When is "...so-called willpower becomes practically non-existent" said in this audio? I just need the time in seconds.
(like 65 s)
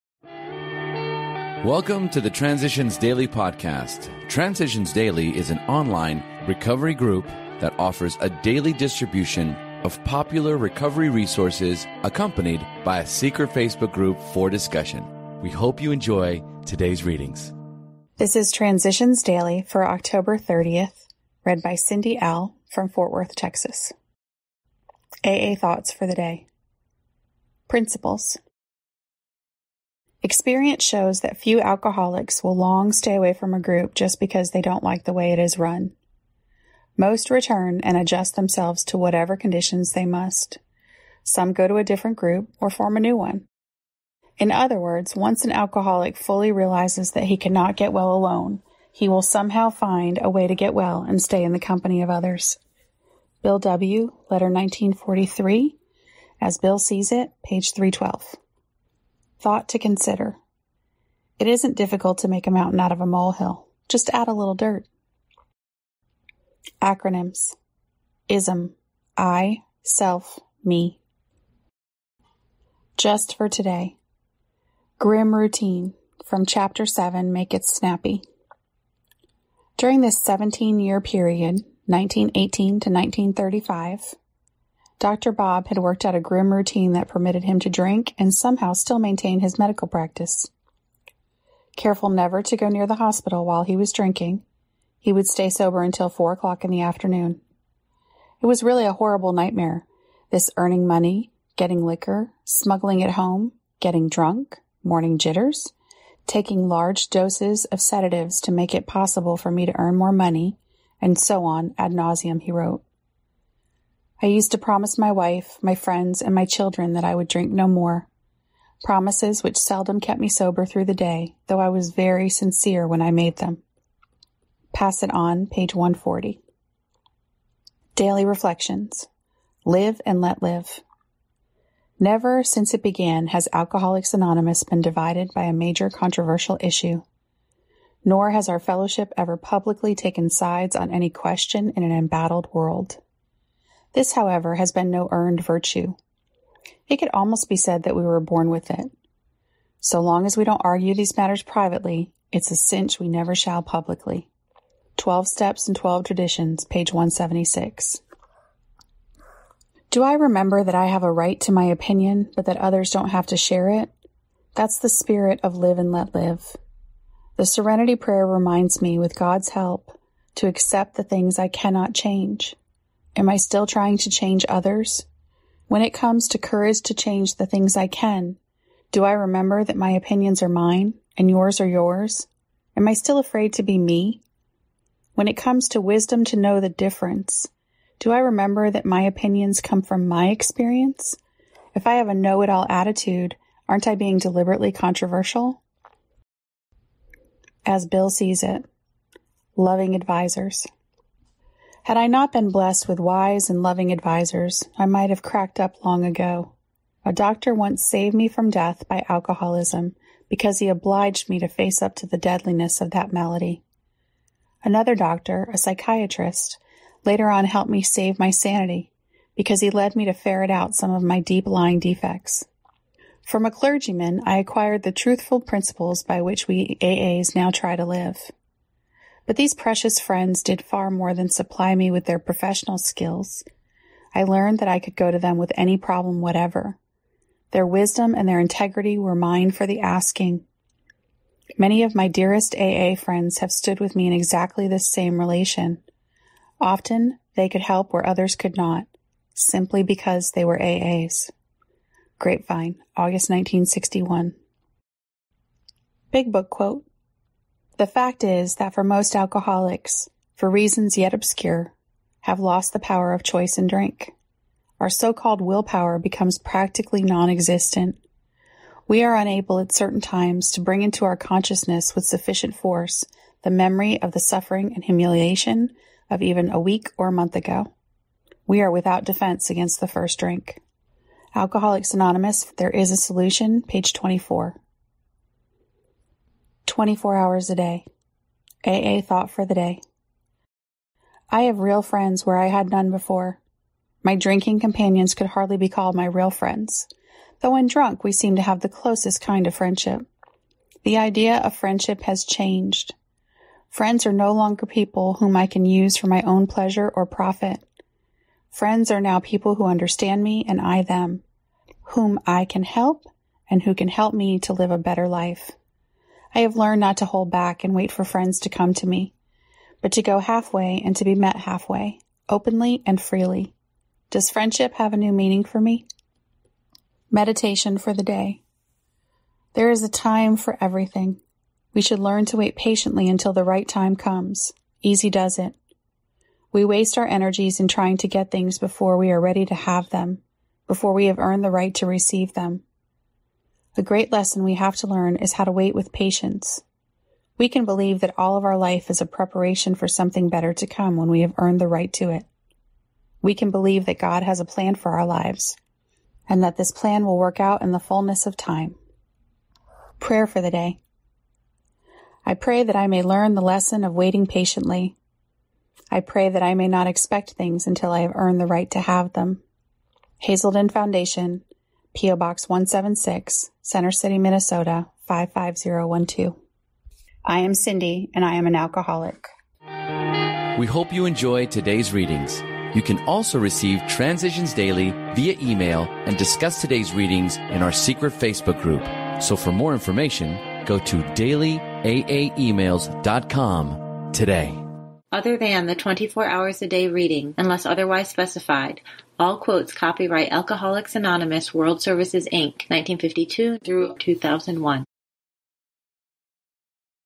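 264 s.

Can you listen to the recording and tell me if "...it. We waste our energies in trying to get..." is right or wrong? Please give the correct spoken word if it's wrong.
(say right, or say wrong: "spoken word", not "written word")
right.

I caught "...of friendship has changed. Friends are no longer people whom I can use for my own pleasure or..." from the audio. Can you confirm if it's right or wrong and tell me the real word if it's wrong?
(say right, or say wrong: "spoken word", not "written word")
right.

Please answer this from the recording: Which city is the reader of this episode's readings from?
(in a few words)
Fort Worth, Texas.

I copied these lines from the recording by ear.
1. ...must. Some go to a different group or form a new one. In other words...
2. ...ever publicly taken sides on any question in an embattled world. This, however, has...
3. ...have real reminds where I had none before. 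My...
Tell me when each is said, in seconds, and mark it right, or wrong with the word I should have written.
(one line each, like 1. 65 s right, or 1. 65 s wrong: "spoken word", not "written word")
1. 40 s right
2. 139 s right
3. 291 s wrong: "friends", not "reminds".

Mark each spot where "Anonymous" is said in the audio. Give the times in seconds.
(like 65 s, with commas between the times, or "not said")
134 s, 281 s, 400 s.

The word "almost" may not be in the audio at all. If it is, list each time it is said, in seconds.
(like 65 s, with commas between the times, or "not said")
147 s.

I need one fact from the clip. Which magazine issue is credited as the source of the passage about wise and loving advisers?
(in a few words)
Grapevine, August 1961.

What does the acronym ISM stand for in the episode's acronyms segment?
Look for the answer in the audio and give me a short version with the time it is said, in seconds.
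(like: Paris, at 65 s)
I, self, me, at 69 s.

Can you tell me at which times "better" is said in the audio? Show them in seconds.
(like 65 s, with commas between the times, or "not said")
314 s, 350 s.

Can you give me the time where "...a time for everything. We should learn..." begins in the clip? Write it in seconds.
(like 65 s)
329 s.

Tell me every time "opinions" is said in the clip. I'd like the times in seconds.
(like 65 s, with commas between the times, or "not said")
161 s, 179 s, 189 s.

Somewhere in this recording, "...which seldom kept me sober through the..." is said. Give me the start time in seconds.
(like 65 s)
119 s.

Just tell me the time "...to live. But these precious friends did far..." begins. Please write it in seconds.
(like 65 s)
227 s.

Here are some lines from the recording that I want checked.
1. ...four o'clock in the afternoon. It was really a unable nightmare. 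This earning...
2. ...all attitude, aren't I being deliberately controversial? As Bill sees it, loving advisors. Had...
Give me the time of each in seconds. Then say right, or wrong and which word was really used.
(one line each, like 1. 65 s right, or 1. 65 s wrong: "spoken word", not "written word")
1. 96 s wrong: "horrible", not "unable"
2. 192 s right.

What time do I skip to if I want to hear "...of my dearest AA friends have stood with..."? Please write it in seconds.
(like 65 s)
241 s.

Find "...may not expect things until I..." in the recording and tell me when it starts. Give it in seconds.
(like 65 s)
366 s.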